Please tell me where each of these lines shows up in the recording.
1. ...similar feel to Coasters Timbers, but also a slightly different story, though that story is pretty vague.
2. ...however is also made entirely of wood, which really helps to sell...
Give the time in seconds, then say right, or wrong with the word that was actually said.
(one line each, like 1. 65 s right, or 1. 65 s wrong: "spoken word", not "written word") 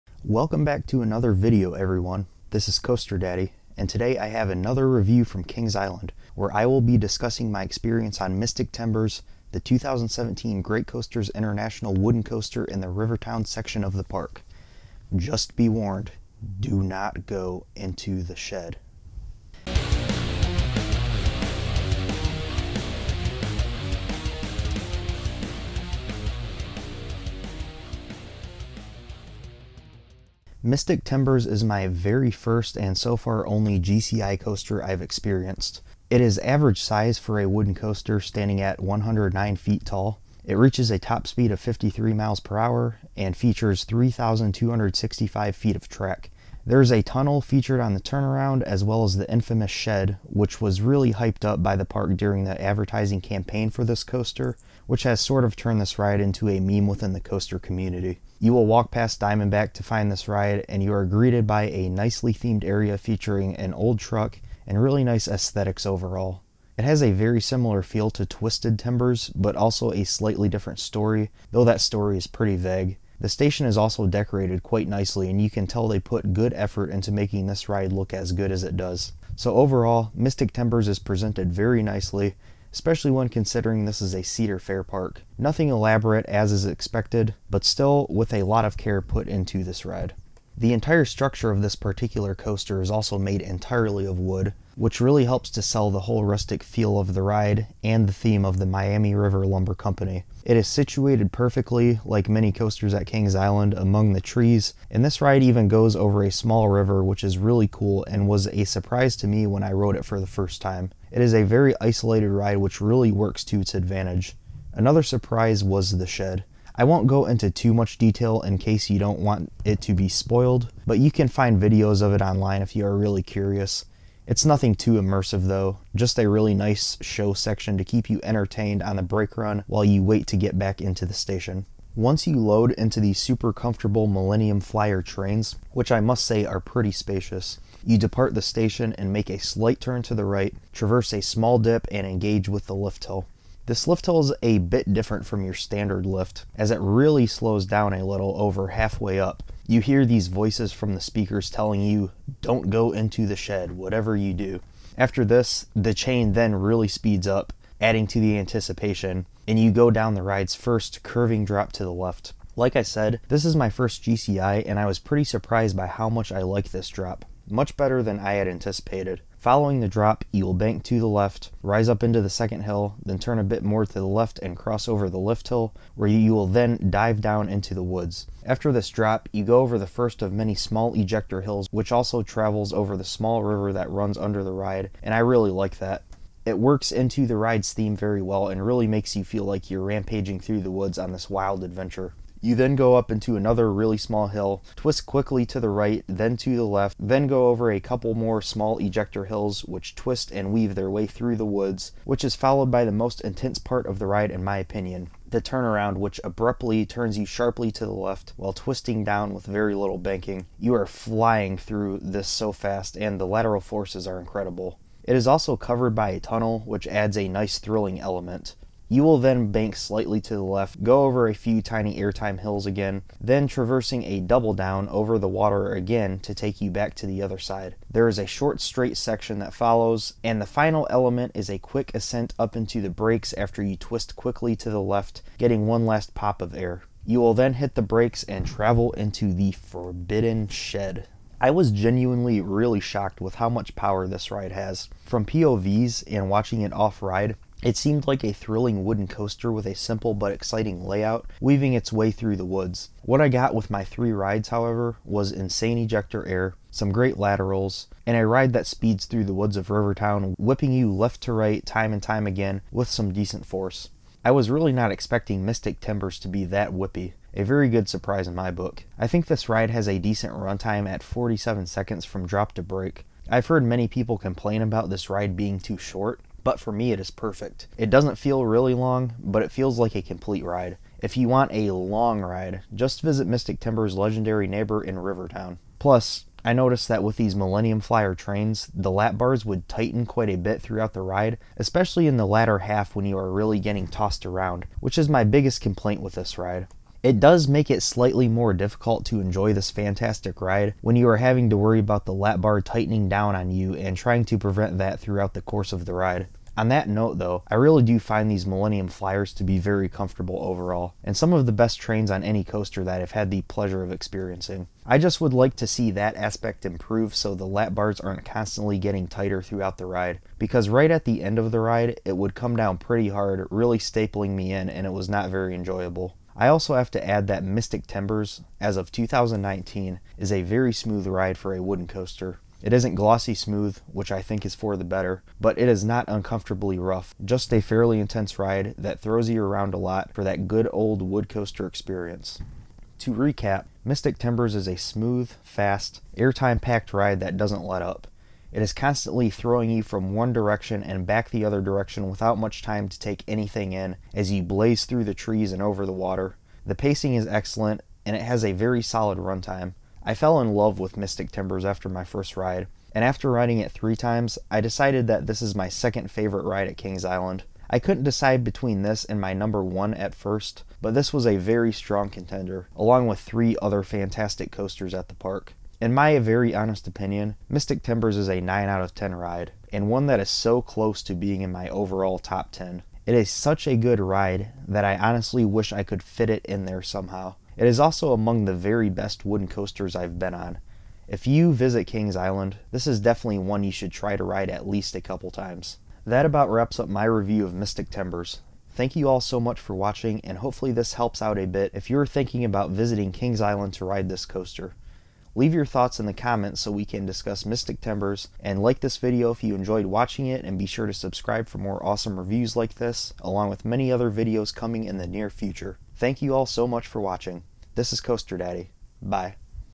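1. 67 s wrong: "Twisted", not "Coasters"
2. 92 s wrong: "coaster", not "however".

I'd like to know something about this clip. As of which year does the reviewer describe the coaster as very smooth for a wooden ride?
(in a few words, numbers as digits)
2019.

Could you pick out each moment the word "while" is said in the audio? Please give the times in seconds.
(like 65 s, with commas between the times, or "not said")
129 s, 208 s.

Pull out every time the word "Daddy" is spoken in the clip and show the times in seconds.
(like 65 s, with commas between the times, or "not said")
3 s, 418 s.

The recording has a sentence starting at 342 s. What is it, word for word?
To recap, Mystic Timbers is a smooth, fast, airtime packed ride that doesn't let up.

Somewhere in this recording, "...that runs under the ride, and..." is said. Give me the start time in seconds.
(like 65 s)
183 s.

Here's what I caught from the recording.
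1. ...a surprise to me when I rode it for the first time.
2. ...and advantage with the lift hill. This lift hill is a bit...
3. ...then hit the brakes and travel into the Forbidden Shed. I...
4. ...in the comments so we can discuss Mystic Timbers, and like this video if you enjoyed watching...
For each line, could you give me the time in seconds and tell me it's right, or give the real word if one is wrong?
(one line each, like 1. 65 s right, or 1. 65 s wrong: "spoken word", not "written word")
1. 108 s right
2. 141 s wrong: "engage", not "advantage"
3. 237 s right
4. 405 s right.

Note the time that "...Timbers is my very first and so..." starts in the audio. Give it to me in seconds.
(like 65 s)
31 s.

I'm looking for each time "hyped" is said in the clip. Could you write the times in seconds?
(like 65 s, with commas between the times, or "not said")
51 s.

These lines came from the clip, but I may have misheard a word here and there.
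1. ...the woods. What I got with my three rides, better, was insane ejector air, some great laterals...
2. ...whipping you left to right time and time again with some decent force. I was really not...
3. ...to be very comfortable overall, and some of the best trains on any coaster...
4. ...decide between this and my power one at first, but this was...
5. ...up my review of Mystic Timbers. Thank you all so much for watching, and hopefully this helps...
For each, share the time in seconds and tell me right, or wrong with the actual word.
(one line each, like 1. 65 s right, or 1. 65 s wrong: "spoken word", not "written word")
1. 252 s wrong: "however", not "better"
2. 260 s right
3. 309 s right
4. 368 s wrong: "number", not "power"
5. 396 s right.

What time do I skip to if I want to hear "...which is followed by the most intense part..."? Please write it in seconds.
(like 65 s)
202 s.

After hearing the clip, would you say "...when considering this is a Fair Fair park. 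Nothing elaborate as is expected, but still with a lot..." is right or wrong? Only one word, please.
wrong.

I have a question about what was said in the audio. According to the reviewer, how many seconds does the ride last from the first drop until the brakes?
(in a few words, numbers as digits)
47.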